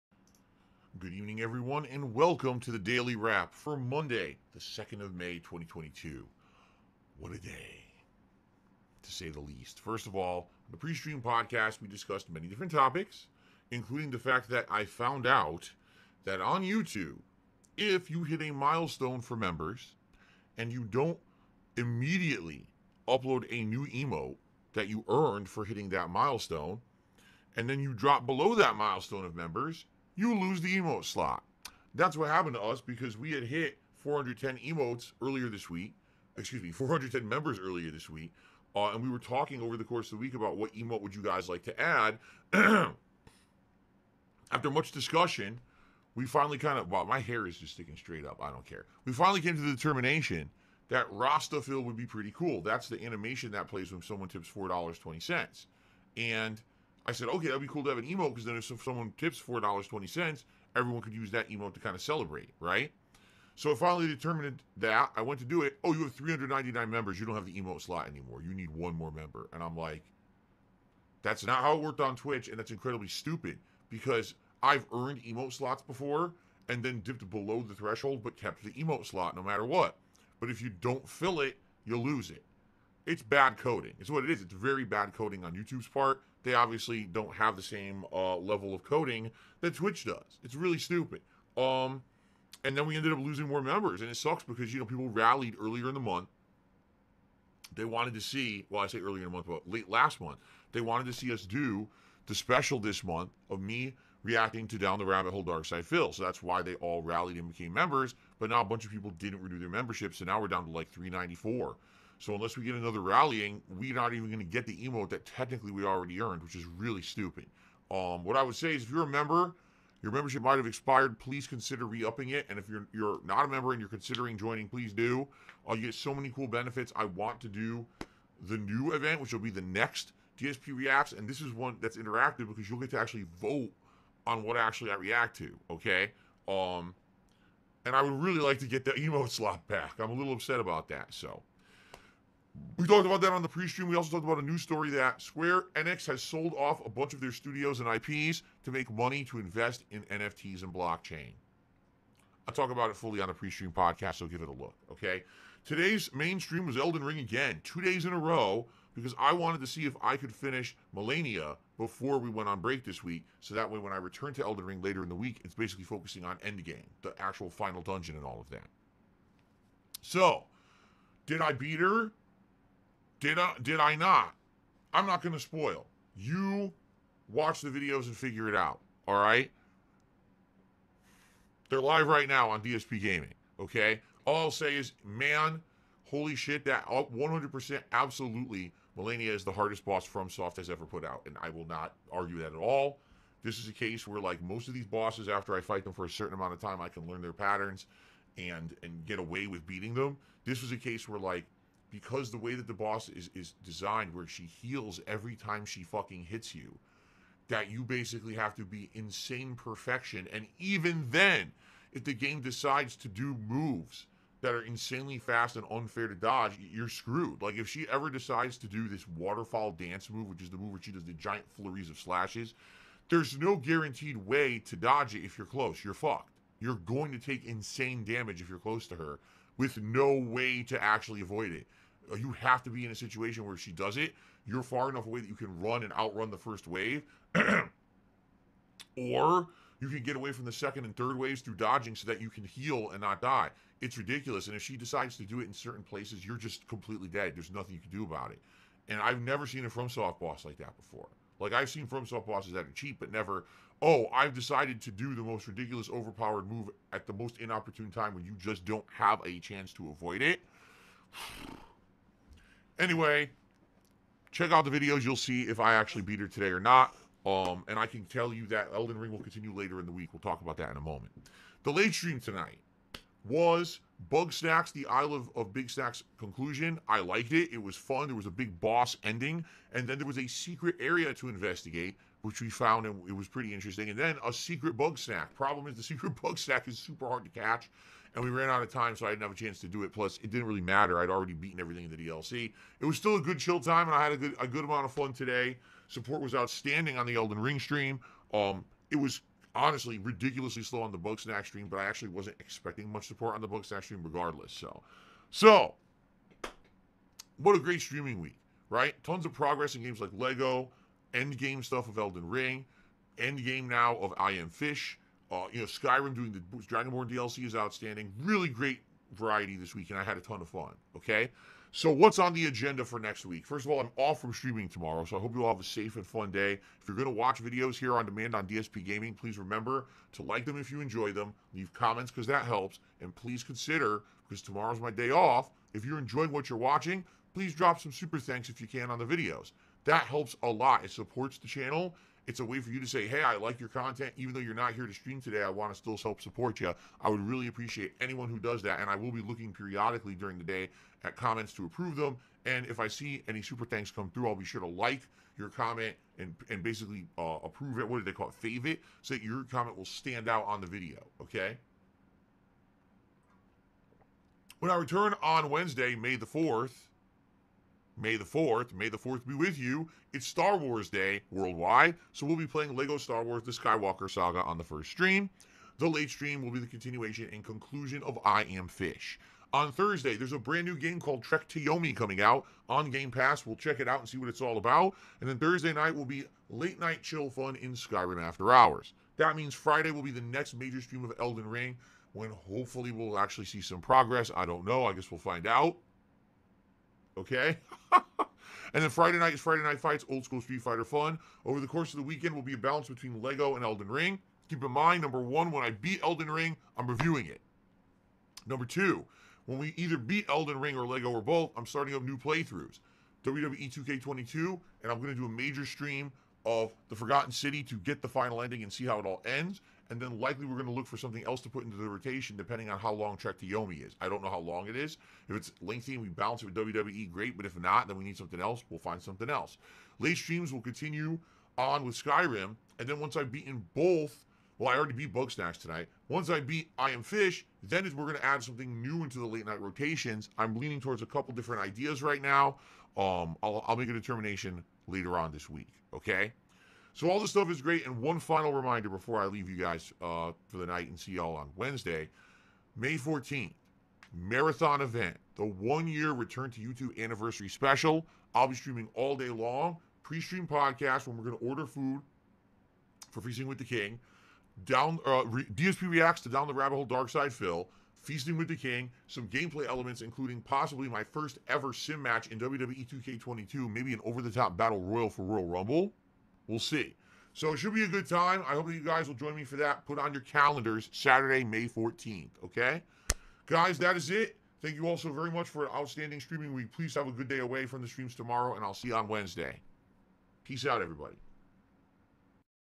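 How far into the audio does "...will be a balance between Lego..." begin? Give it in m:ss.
6:42.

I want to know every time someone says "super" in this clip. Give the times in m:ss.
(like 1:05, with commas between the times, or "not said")
4:46, 5:37, 5:53.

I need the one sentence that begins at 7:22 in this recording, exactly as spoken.
Um, I'll, I'll make a determination later on this week.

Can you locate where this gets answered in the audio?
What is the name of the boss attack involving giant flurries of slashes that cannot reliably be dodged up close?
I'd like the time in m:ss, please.
3:39.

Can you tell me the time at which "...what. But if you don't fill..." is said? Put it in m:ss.
1:19.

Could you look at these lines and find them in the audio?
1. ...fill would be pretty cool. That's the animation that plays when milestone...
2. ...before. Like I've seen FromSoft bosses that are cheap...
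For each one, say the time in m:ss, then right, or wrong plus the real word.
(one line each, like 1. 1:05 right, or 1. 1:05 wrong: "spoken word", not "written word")
1. 0:51 wrong: "someone", not "milestone"
2. 4:10 right.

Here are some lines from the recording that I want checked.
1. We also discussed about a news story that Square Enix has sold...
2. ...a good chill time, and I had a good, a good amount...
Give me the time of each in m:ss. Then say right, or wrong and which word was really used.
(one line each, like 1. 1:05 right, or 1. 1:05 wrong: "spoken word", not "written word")
1. 2:23 wrong: "talked", not "discussed"
2. 4:53 right.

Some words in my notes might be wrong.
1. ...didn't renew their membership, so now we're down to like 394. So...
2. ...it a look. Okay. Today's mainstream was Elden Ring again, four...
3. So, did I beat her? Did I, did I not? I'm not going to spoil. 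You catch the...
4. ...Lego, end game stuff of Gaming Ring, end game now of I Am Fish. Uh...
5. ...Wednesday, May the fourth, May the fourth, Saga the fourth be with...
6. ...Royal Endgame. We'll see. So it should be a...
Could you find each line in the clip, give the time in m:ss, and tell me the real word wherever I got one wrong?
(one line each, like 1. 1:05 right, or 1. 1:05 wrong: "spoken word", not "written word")
1. 1:49 right
2. 2:34 wrong: "two", not "four"
3. 2:50 wrong: "watch", not "catch"
4. 5:10 wrong: "Elden", not "Gaming"
5. 6:05 wrong: "May", not "Saga"
6. 7:55 wrong: "Rumble", not "Endgame".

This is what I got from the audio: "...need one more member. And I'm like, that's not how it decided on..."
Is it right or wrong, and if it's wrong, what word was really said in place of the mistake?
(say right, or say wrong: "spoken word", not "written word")
wrong: "worked", not "decided".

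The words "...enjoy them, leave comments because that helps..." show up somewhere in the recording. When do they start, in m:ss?
5:30.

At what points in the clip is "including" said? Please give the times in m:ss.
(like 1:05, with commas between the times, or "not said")
0:13, 7:50.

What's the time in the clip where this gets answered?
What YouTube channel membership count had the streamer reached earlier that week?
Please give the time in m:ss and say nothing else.
0:36.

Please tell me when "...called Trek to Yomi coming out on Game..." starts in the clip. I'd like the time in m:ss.
6:20.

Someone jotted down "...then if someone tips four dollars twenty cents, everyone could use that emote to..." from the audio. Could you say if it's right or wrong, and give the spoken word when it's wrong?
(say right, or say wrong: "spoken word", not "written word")
right.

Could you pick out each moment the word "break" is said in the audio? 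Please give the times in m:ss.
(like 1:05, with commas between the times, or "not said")
2:42.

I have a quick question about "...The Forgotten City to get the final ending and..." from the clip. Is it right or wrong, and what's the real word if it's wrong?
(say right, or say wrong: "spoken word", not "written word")
right.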